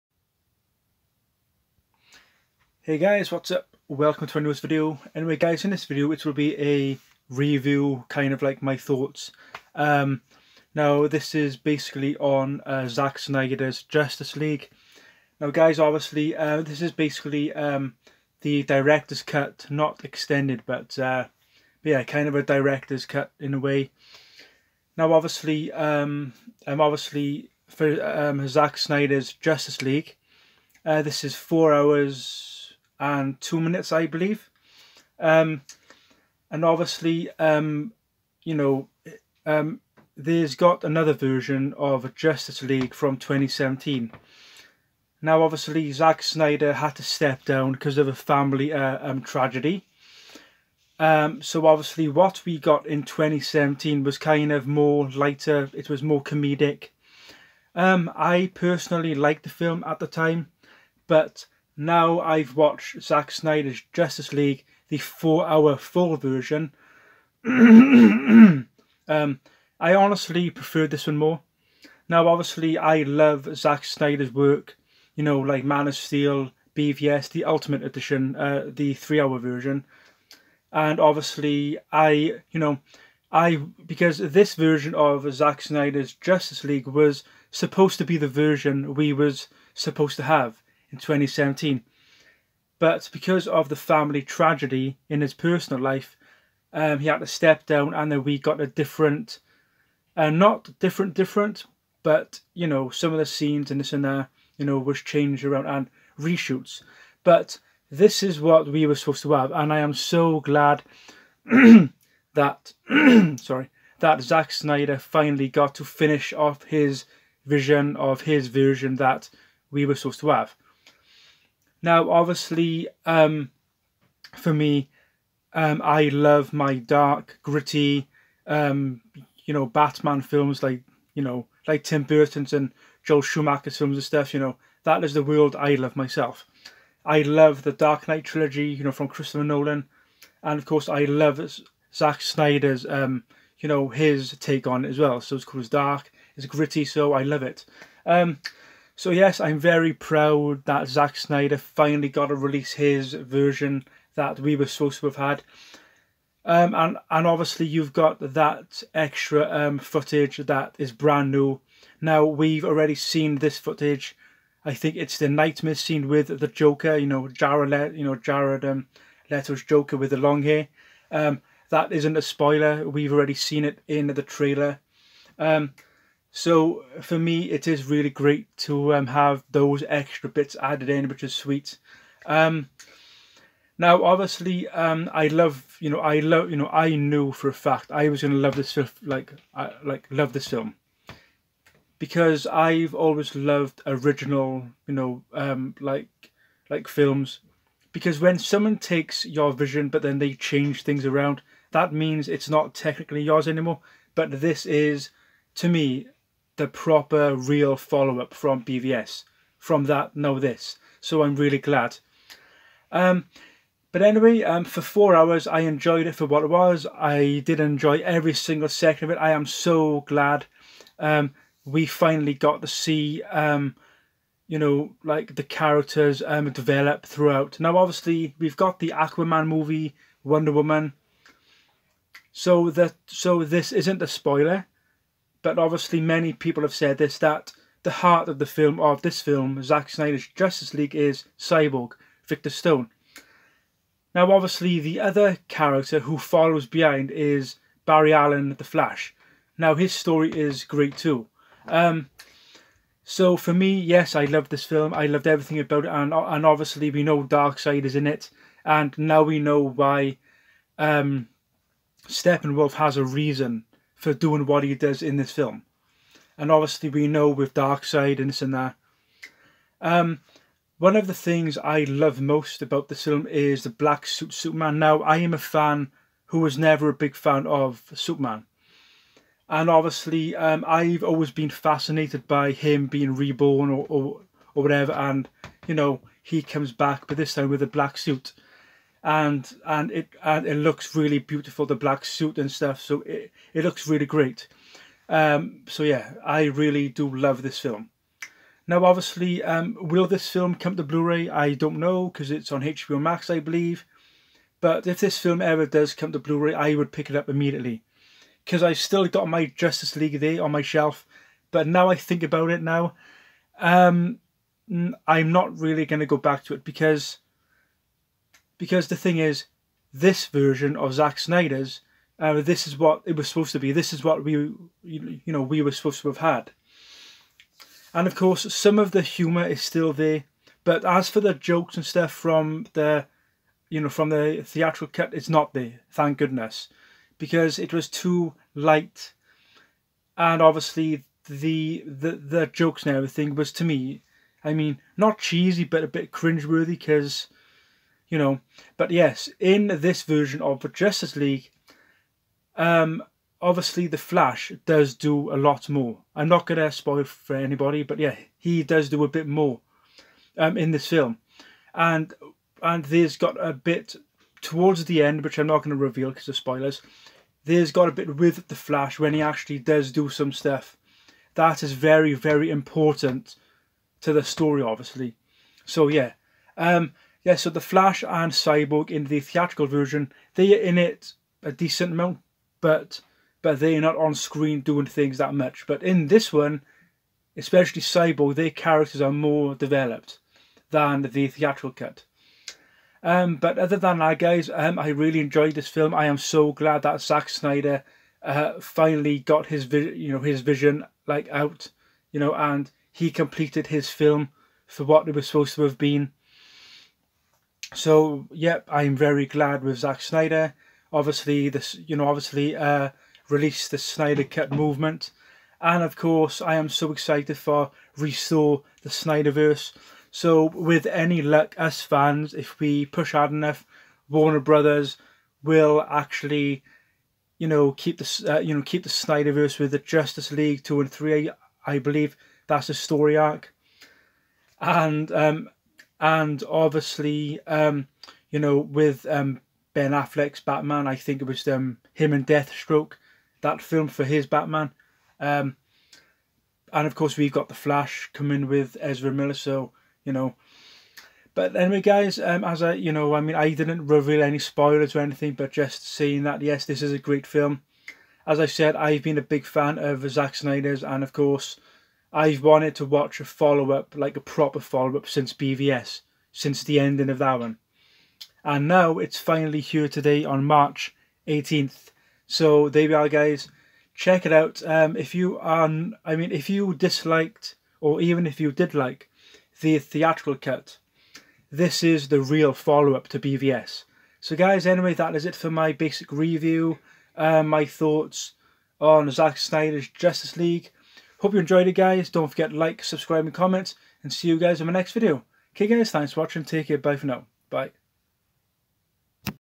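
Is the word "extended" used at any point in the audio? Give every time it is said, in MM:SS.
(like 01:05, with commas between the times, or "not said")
00:20.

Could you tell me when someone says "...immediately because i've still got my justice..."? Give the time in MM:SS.
05:07.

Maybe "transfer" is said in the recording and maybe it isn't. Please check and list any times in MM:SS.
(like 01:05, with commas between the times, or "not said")
not said.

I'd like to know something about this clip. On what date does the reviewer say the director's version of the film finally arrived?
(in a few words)
March 18th.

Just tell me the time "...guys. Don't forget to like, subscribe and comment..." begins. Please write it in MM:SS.
08:11.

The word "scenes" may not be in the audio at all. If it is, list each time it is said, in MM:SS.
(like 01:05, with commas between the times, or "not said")
01:43, 02:45.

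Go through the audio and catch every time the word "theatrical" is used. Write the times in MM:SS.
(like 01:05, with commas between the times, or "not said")
05:34, 06:19, 06:31, 07:59.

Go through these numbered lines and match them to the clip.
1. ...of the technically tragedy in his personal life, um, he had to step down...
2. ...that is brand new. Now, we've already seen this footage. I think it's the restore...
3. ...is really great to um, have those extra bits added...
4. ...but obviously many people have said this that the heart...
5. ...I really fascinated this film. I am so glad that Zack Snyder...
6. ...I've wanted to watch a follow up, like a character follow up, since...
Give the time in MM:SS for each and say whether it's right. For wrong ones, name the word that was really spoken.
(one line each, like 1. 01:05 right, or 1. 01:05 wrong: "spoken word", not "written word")
1. 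01:33 wrong: "family", not "technically"
2. 02:40 wrong: "nightmare", not "restore"
3. 02:57 right
4. 03:55 right
5. 06:34 wrong: "enjoyed", not "fascinated"
6. 07:42 wrong: "proper", not "character".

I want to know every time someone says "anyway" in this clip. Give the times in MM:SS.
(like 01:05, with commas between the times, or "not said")
00:05, 03:34, 07:31, 08:04.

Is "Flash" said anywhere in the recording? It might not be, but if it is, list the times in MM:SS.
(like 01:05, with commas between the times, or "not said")
04:08, 05:53, 06:08, 06:17, 07:27.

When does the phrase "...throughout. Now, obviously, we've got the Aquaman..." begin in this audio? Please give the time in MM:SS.
03:47.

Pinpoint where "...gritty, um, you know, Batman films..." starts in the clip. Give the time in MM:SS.
02:07.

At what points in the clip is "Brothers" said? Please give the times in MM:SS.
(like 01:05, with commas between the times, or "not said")
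07:04.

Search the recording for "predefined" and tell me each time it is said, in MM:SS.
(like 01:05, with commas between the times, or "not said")
not said.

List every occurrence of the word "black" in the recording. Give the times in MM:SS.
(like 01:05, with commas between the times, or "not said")
04:33, 04:47, 04:51.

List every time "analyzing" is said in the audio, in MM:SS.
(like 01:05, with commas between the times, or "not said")
not said.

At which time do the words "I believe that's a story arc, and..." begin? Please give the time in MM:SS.
07:11.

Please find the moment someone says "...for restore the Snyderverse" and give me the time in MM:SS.
06:57.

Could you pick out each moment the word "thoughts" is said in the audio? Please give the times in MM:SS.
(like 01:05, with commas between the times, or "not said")
00:08, 08:07.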